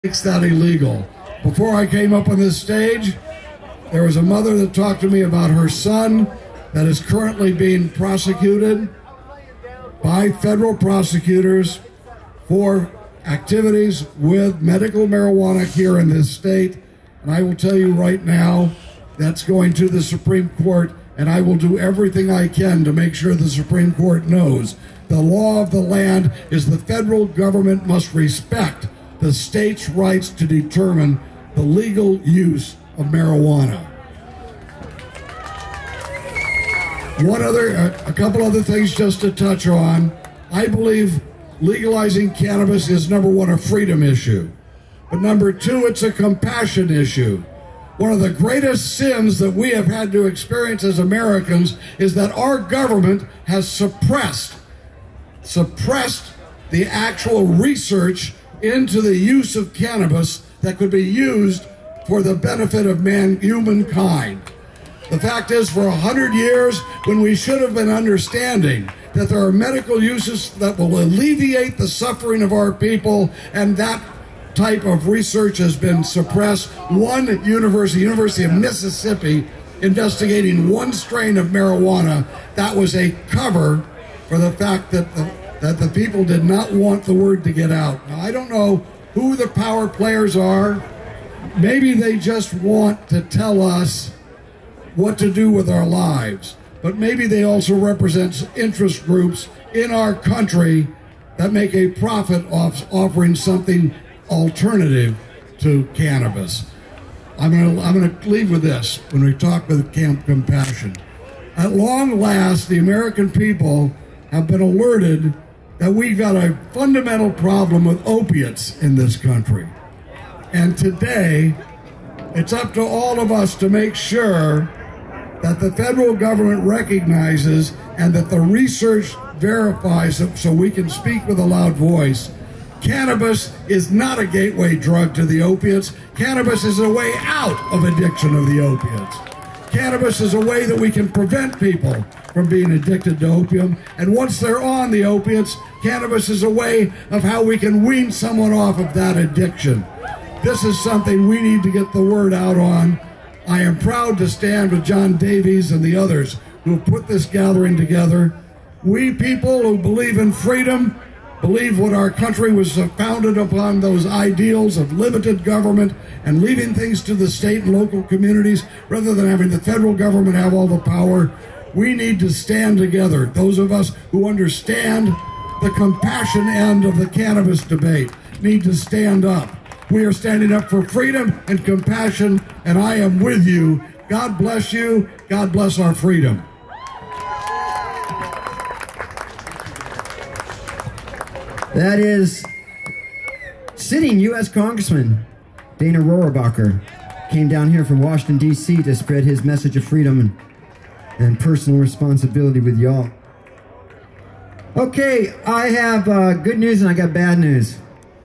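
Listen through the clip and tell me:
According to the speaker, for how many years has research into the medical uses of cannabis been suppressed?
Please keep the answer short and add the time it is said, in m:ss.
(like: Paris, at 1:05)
100, at 1:05.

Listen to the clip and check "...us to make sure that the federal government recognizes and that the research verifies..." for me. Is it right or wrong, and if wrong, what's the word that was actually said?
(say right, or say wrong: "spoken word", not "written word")
right.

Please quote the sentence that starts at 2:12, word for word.
Cannabis is not a gateway drug to the opiates.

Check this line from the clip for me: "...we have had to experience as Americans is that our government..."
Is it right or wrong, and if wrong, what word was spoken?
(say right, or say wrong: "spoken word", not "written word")
right.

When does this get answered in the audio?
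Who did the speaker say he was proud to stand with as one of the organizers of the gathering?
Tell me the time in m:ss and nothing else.
2:34.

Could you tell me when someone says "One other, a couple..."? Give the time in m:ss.
0:37.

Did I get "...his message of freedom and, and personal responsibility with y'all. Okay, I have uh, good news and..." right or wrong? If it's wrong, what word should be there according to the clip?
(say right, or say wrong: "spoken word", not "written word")
right.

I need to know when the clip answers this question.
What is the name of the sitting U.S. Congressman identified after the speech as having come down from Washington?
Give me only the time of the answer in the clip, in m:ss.
3:15.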